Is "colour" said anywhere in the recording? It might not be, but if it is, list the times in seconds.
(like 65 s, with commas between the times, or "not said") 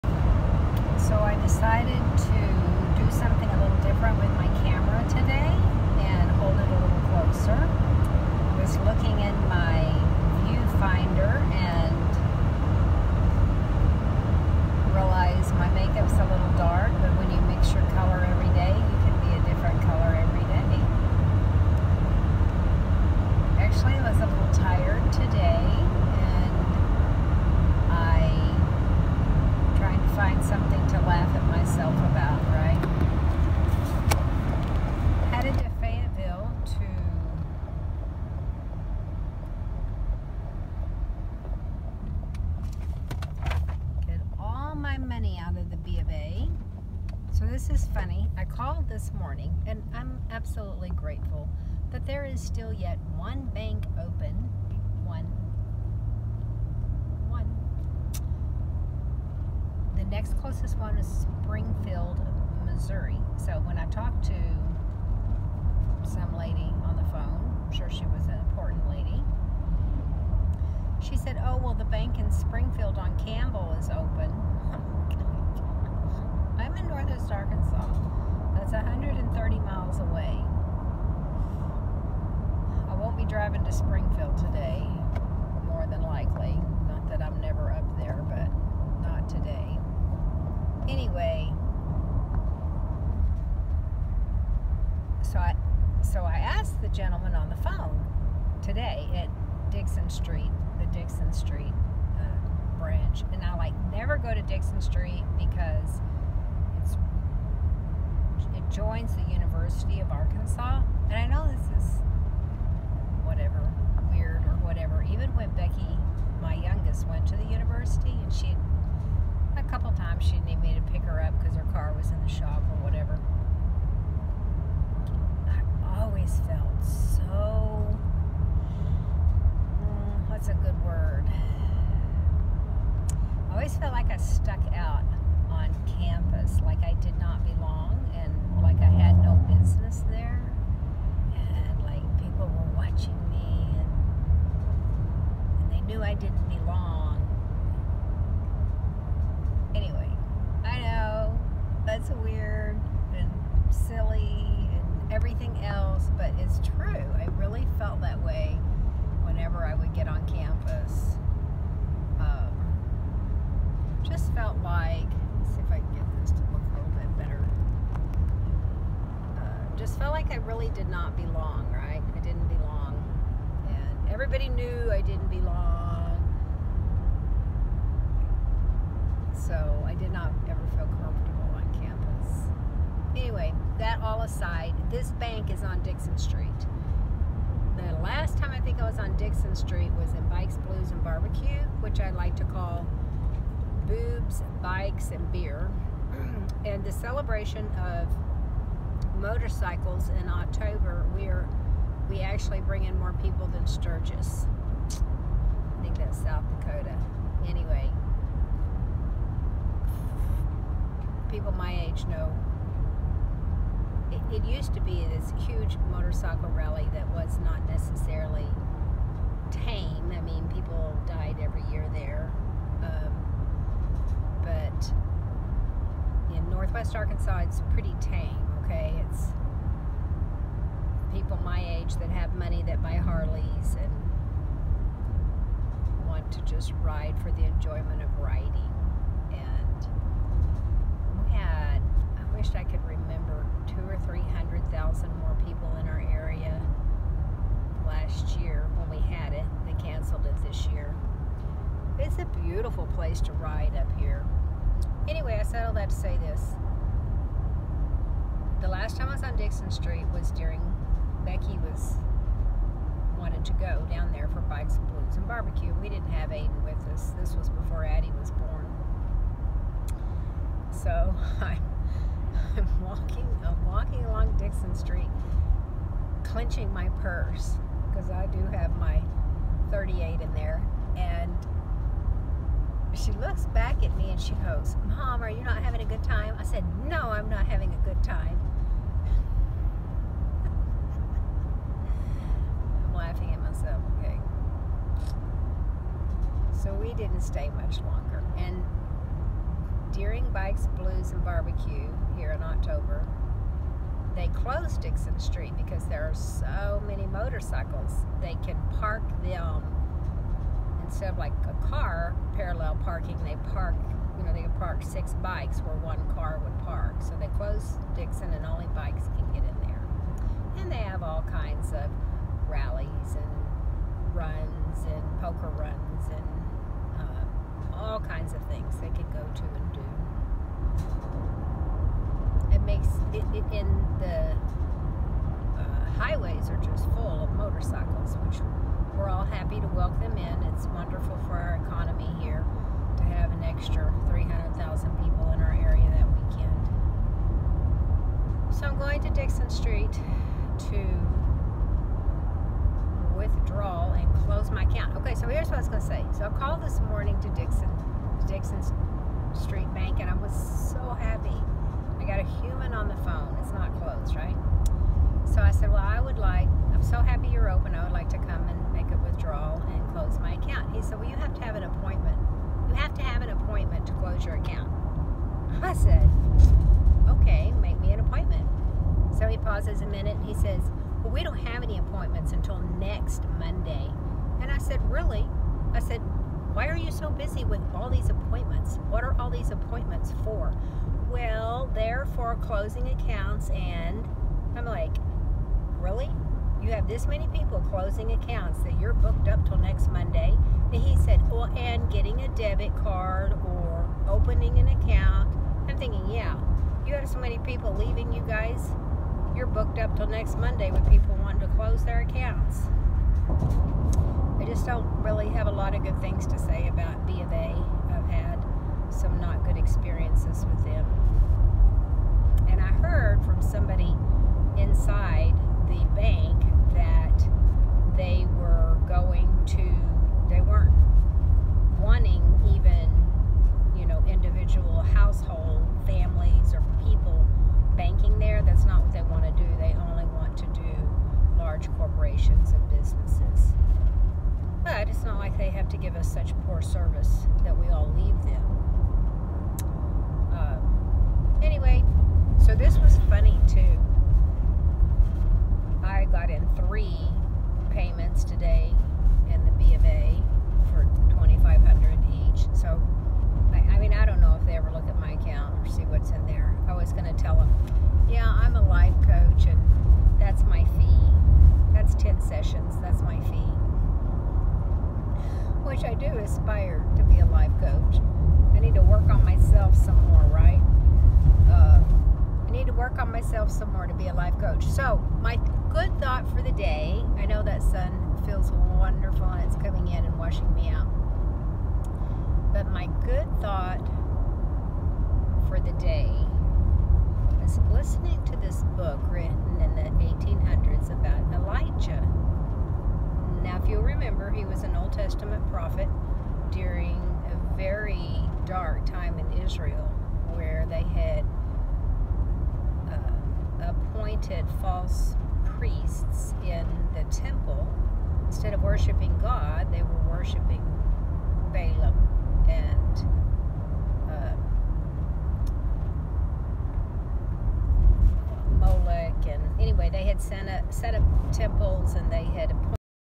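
not said.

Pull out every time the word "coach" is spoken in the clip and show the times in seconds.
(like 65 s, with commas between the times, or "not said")
469 s, 477 s, 484 s.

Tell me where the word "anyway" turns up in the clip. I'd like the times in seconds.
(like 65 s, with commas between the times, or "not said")
90 s, 149 s, 183 s, 207 s, 255 s, 451 s, 529 s.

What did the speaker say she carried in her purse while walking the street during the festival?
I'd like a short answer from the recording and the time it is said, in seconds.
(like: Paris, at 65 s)
38, at 279 s.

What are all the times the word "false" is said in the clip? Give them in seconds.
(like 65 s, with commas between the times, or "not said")
514 s.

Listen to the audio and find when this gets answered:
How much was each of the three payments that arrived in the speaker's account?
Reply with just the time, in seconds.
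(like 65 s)
461 s.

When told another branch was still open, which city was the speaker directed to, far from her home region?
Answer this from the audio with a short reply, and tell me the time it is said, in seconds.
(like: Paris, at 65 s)
Springfield, Missouri, at 61 s.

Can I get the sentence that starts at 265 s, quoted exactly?
We didn't have Aiden with us.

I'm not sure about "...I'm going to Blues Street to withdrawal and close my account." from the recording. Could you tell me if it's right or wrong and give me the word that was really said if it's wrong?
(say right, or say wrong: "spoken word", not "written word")
wrong: "Dickson", not "Blues".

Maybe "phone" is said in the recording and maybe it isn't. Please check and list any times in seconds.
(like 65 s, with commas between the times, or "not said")
67 s, 97 s, 363 s.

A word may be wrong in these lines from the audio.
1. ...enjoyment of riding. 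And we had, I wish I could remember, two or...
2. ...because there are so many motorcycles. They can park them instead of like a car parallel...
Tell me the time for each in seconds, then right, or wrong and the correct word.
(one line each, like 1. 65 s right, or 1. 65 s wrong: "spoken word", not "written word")
1. 237 s right
2. 305 s right.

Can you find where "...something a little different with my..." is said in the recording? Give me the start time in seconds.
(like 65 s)
3 s.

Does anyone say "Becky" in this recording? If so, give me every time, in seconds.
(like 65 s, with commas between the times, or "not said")
115 s, 261 s.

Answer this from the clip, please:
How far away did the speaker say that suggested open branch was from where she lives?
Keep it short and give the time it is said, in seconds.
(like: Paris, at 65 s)
130 miles, at 78 s.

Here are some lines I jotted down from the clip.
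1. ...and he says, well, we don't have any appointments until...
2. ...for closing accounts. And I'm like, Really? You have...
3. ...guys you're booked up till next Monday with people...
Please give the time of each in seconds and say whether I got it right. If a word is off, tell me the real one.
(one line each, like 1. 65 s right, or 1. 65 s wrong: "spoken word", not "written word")
1. 380 s right
2. 392 s right
3. 408 s right.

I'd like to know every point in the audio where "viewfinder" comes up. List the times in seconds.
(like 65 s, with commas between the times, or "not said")
10 s.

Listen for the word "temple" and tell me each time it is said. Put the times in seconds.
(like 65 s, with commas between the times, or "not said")
517 s, 531 s.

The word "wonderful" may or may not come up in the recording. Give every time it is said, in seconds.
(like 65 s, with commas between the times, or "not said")
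340 s, 488 s.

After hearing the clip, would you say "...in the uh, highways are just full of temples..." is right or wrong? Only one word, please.
wrong.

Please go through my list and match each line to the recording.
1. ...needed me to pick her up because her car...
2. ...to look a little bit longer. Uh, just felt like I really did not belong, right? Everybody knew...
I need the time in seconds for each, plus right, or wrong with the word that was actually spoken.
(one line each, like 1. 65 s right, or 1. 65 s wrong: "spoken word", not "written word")
1. 120 s right
2. 166 s wrong: "better", not "longer".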